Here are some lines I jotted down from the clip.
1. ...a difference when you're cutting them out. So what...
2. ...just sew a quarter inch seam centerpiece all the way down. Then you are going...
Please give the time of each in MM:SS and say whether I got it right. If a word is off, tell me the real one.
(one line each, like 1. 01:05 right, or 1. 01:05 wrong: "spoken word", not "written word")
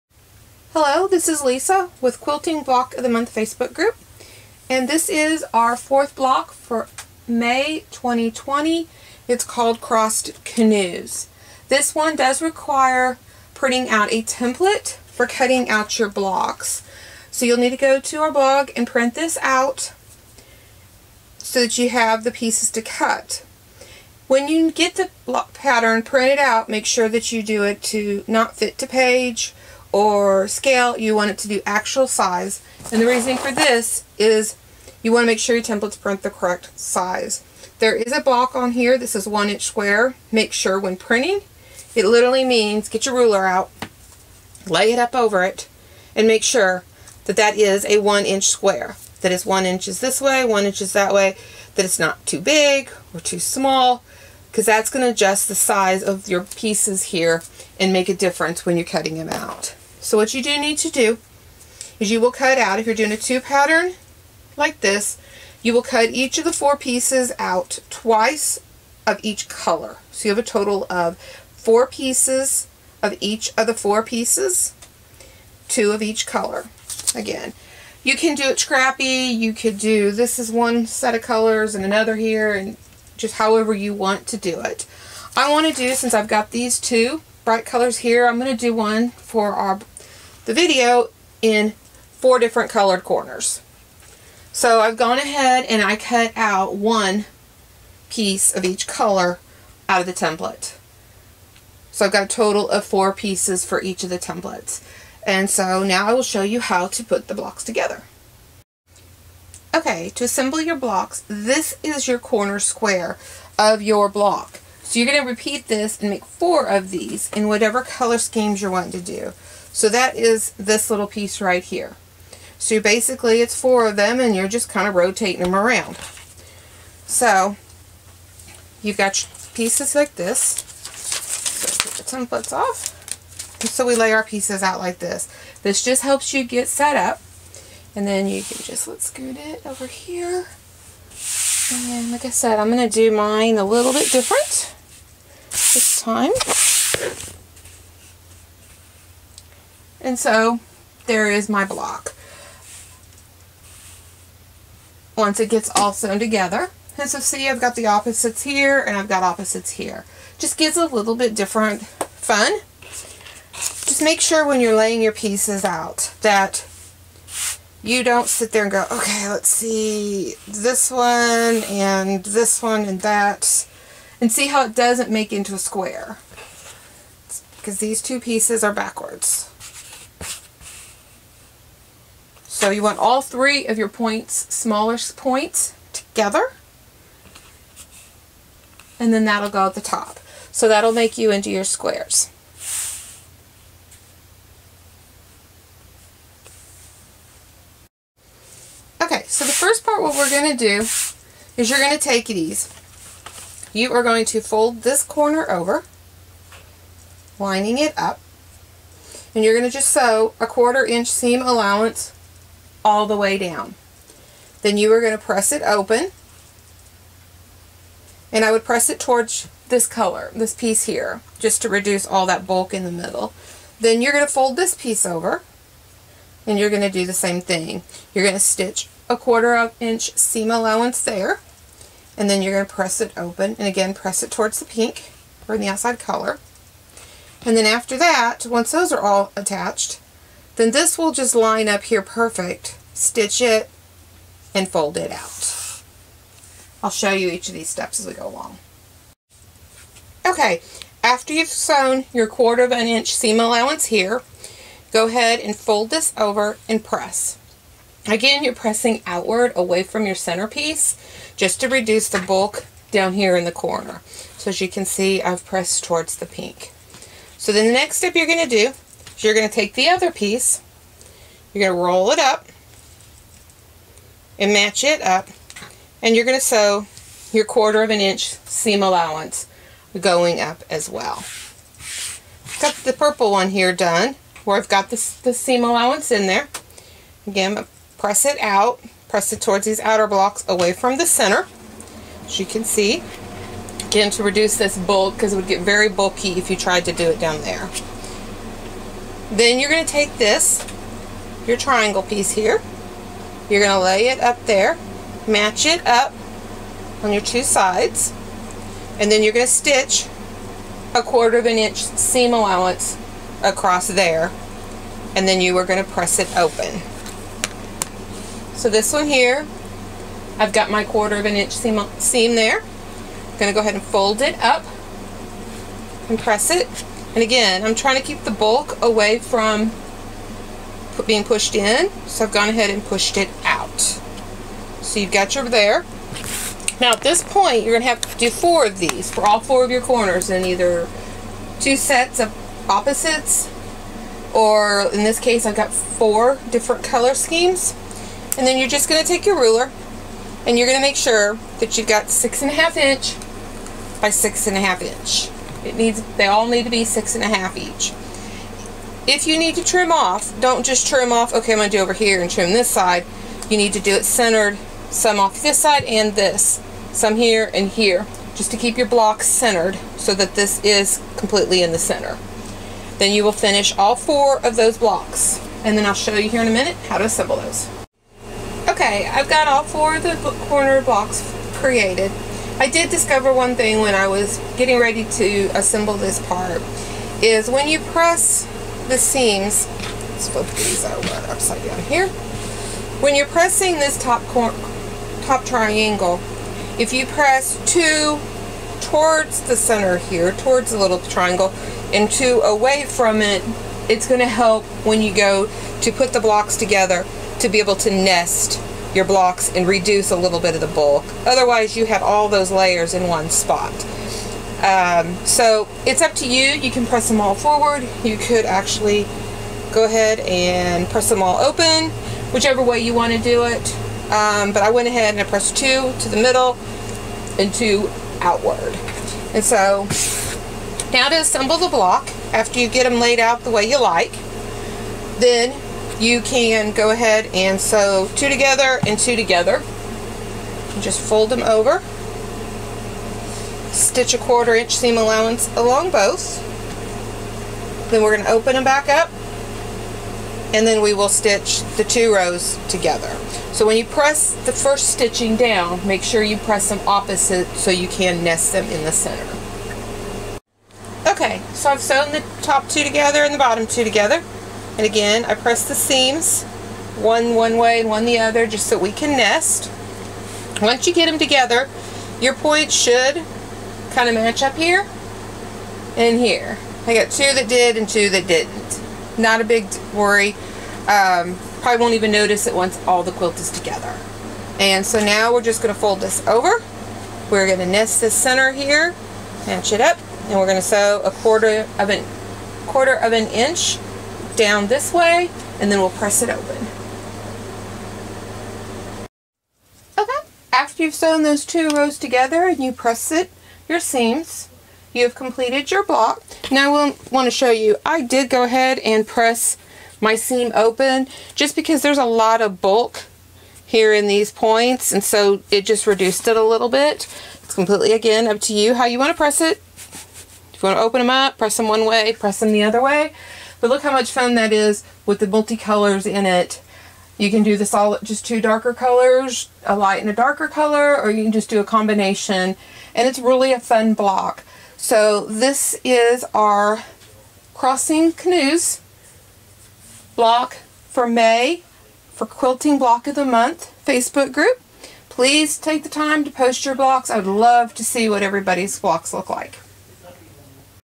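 1. 00:58 right
2. 03:29 wrong: "allowance", not "centerpiece".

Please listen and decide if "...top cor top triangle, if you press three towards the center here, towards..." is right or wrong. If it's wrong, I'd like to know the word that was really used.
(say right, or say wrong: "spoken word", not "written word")
wrong: "two", not "three".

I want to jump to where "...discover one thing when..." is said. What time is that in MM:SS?
06:22.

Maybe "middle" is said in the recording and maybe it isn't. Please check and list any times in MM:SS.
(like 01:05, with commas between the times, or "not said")
03:42, 07:06.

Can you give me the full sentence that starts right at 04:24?
So as you can see, I've pressed towards the pink.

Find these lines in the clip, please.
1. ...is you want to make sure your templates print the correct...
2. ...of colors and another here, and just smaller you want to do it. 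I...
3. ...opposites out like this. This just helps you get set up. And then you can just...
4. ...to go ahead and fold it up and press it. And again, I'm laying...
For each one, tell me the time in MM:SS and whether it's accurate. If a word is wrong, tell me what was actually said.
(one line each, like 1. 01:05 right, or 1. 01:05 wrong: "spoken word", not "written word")
1. 00:34 right
2. 01:21 wrong: "however", not "smaller"
3. 02:14 wrong: "pieces", not "opposites"
4. 05:23 wrong: "trying", not "laying".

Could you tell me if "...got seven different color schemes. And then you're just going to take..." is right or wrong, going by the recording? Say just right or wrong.
wrong.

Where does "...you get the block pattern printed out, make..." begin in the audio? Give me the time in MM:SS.
00:24.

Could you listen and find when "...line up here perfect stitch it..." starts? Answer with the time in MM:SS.
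04:01.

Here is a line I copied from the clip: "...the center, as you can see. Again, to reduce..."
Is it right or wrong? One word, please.
right.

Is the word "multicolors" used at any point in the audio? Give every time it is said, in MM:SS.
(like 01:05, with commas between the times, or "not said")
08:45.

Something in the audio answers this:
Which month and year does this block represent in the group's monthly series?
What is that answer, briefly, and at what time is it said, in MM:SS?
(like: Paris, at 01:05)
May 2020, at 00:07.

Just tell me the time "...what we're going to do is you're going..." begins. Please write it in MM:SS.
03:20.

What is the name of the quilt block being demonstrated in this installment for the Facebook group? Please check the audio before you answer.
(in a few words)
Crossed Canoes.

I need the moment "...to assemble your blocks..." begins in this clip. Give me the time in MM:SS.
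01:50.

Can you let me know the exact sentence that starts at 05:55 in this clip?
It needs, they all need to be six and a half each.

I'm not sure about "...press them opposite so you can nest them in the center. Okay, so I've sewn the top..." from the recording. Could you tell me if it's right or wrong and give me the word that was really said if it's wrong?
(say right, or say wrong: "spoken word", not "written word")
right.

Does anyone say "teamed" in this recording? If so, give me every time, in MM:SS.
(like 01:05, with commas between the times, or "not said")
not said.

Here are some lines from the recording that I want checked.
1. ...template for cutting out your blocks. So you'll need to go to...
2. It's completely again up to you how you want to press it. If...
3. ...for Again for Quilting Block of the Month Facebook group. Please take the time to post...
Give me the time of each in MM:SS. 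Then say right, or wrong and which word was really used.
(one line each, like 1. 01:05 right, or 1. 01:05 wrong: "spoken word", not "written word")
1. 00:14 right
2. 08:37 right
3. 09:00 wrong: "May", not "Again".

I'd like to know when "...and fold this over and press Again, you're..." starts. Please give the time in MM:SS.
04:15.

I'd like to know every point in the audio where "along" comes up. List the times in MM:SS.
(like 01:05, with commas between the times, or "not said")
04:08, 07:25.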